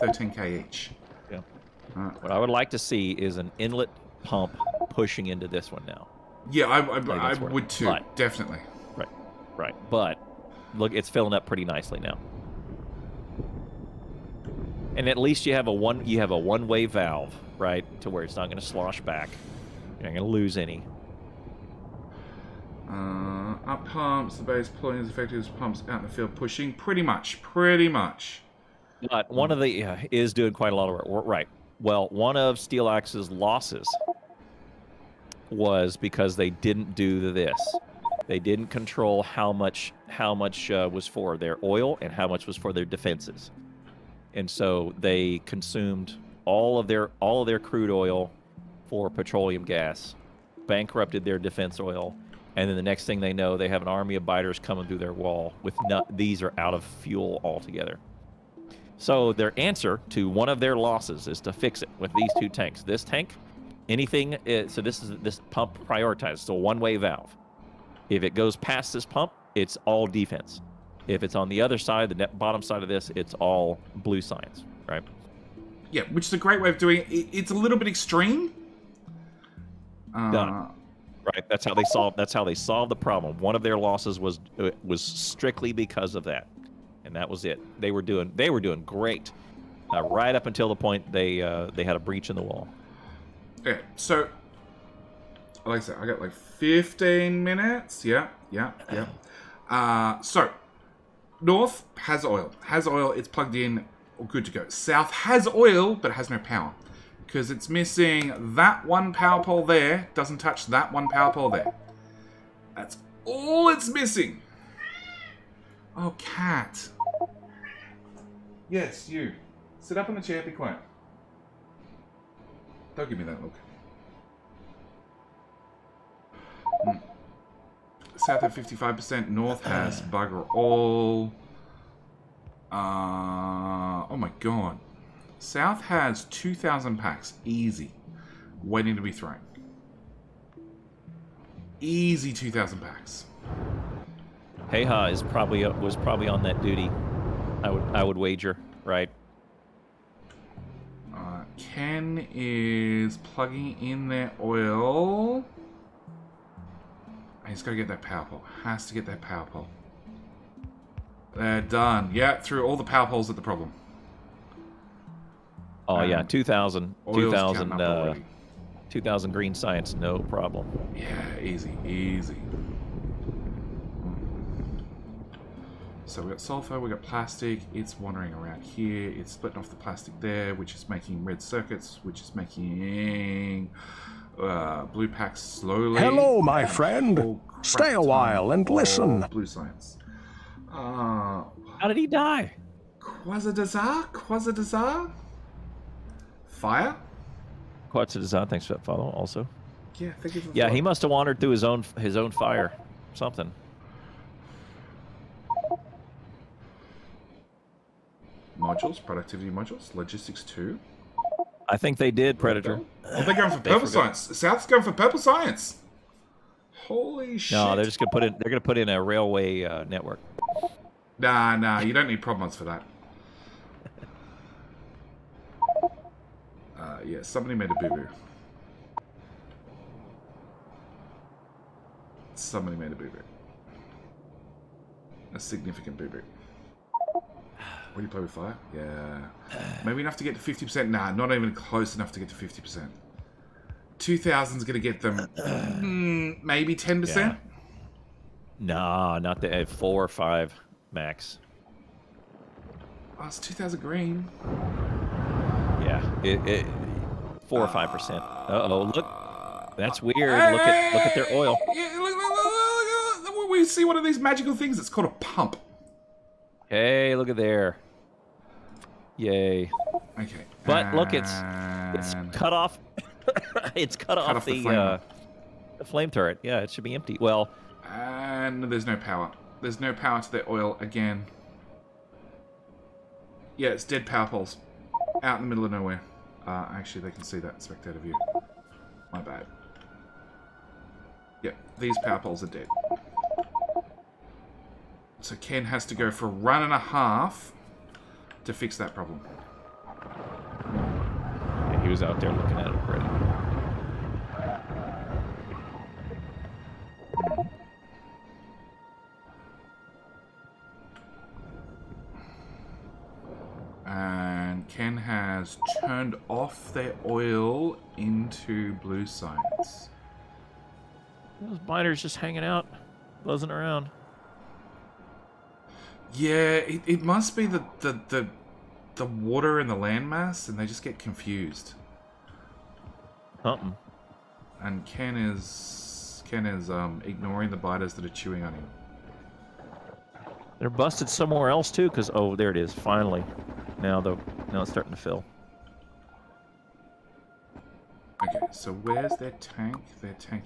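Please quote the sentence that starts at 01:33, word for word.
Okay, So, like I said, I got like 15 minutes.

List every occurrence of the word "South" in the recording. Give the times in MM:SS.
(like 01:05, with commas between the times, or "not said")
01:44, 02:08, 02:15, 03:34.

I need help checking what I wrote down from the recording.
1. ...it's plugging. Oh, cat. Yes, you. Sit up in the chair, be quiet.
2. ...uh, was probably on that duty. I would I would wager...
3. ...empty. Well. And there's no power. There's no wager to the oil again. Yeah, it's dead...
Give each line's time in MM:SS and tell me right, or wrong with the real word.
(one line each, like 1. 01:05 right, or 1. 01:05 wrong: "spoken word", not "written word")
1. 01:53 wrong: "missing", not "plugging"
2. 02:25 right
3. 04:36 wrong: "power", not "wager".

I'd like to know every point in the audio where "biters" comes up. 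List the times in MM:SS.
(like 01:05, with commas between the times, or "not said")
00:54, 05:37.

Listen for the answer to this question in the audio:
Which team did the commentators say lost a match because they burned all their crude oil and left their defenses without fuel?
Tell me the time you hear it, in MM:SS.
00:32.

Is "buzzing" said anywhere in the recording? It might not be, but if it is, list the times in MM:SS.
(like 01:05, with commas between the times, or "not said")
05:23.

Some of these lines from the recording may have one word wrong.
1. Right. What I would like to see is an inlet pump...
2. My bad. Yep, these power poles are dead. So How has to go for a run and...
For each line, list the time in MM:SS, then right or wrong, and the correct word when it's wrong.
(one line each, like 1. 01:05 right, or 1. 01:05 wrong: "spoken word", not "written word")
1. 00:01 right
2. 04:49 wrong: "Ken", not "How".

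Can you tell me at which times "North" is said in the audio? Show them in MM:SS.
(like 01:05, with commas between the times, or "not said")
01:41, 02:09.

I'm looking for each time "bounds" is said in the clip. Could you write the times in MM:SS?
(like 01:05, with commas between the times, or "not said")
not said.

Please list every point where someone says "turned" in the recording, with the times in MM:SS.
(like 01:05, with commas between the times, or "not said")
05:15.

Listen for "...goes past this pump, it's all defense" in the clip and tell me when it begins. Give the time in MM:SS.
01:08.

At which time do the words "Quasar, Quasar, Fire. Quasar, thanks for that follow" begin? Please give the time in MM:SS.
03:13.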